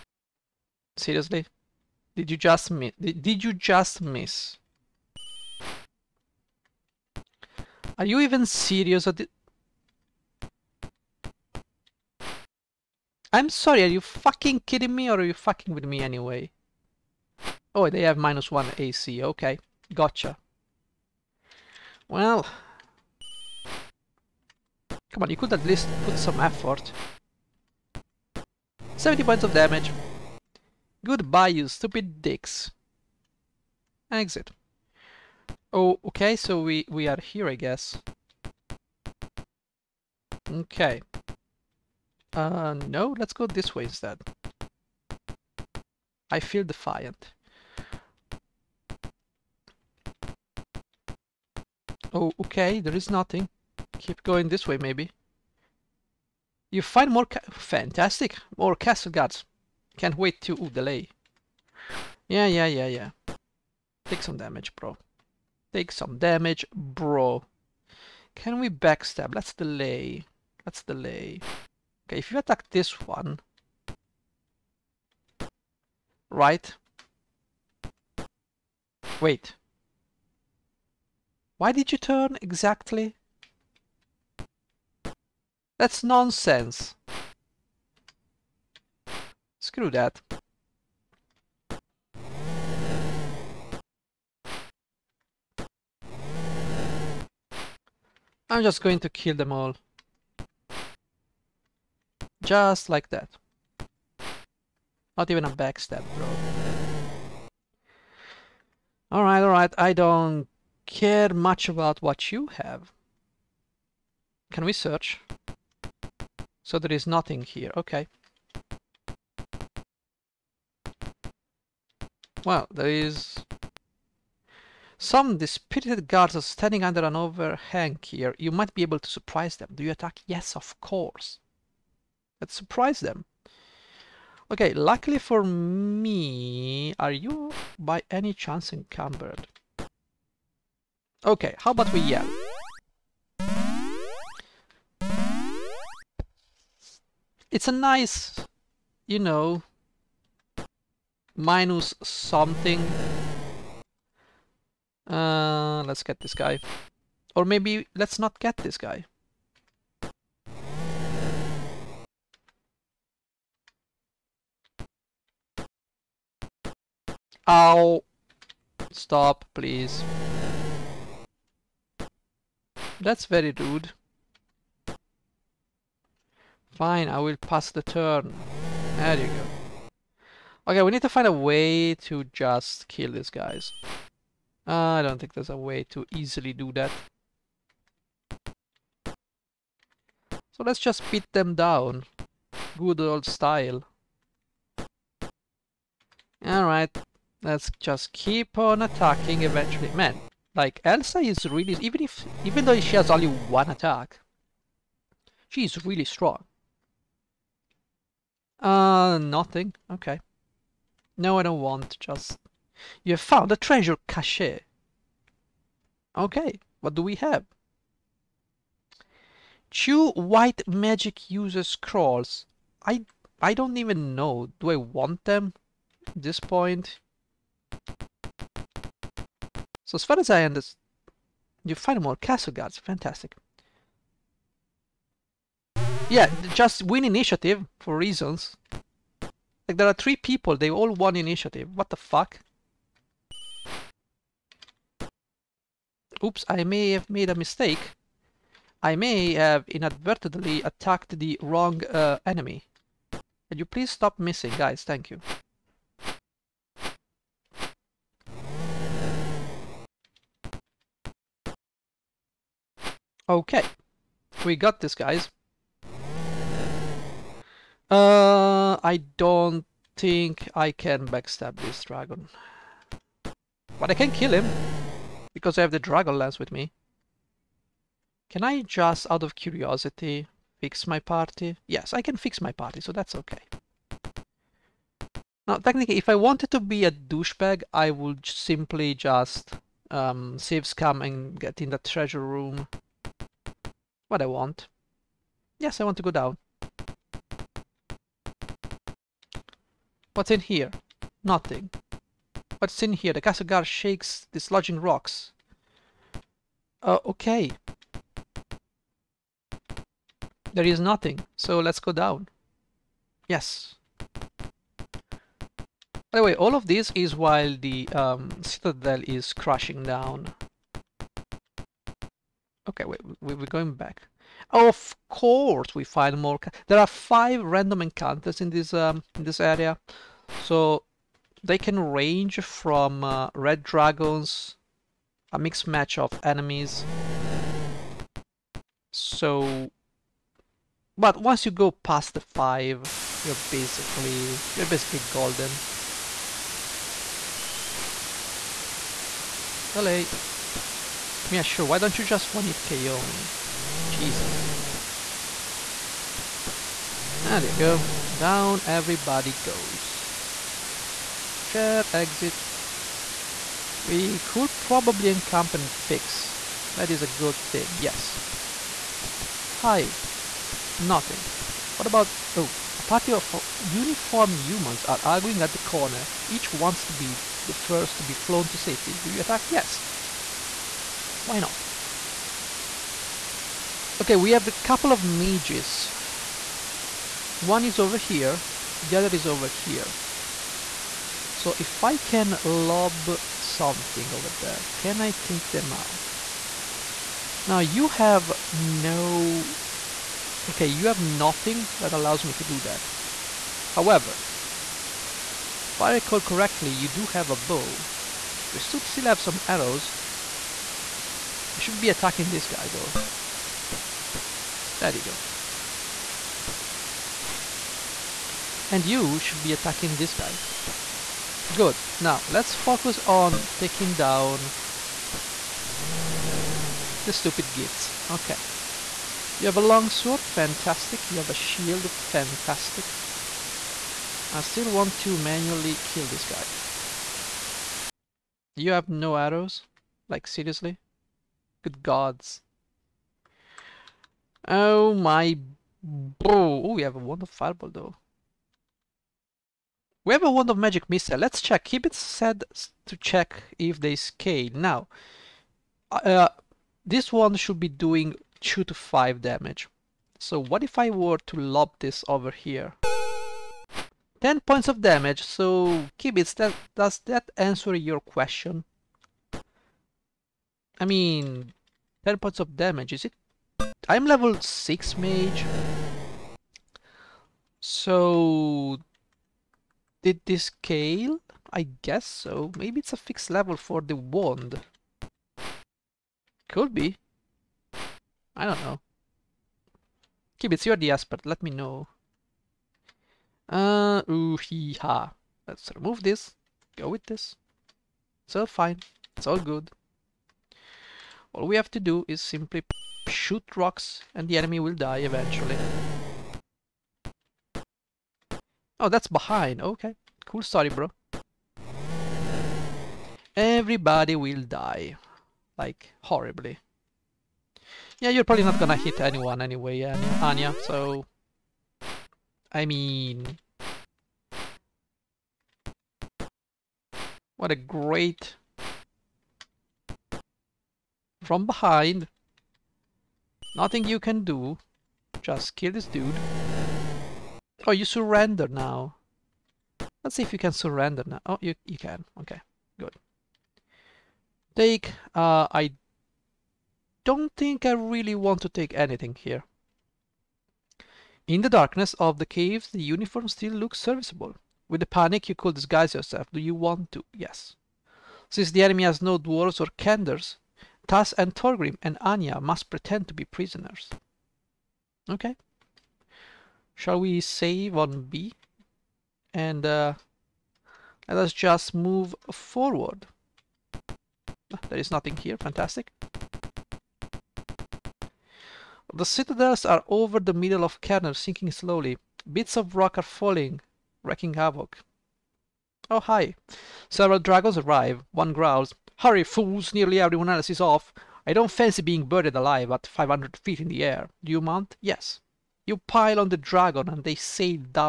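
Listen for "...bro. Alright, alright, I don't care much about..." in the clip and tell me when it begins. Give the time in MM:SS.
01:46.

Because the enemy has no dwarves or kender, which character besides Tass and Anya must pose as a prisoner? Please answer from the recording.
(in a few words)
Torgrim.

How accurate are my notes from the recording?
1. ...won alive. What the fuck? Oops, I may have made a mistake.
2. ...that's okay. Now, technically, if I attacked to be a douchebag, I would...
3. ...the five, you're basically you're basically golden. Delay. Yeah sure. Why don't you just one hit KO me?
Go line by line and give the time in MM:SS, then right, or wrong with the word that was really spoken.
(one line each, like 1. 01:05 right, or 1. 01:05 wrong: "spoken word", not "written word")
1. 04:00 wrong: "initiative", not "alive"
2. 04:42 wrong: "wanted", not "attacked"
3. 05:42 right.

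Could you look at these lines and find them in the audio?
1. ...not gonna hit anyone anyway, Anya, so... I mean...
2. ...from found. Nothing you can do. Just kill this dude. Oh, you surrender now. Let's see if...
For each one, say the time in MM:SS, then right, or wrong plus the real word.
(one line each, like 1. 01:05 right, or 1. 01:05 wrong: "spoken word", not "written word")
1. 08:38 right
2. 08:51 wrong: "behind", not "found".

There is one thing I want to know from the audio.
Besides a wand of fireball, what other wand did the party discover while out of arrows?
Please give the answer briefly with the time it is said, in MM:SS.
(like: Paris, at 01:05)
wand of magic missile, at 07:30.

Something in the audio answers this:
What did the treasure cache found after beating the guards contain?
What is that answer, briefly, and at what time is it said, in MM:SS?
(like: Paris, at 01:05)
Two white magic user scrolls, at 03:39.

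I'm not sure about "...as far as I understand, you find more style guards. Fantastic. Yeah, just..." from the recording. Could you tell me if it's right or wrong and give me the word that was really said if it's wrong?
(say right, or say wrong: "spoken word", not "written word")
wrong: "castle", not "style".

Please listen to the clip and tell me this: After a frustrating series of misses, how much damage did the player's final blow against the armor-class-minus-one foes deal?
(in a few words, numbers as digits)
70 points.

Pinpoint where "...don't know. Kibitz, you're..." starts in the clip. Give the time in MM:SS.
08:08.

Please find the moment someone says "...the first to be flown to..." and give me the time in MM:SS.
06:17.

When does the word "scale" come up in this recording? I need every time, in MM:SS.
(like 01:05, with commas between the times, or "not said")
07:33, 08:00.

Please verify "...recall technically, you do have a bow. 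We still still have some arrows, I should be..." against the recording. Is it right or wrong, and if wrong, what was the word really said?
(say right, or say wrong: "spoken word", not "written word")
wrong: "correctly", not "technically".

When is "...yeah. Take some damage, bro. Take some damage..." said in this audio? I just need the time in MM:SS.
01:02.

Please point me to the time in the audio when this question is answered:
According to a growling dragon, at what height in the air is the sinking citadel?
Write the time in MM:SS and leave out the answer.
09:52.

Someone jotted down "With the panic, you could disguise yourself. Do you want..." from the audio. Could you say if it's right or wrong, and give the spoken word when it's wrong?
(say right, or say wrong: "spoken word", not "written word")
right.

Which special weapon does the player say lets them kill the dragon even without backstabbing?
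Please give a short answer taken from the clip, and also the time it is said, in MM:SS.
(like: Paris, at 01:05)
dragon lance, at 04:35.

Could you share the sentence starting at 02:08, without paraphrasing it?
You might be able to surprise them.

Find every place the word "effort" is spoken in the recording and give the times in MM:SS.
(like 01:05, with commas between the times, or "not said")
00:26.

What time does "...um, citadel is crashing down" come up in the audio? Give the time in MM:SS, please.
05:17.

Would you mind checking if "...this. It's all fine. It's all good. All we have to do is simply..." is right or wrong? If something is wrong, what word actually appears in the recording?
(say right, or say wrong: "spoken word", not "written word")
right.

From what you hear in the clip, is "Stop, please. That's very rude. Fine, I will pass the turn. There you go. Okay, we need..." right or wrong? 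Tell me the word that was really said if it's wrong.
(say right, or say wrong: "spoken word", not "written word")
right.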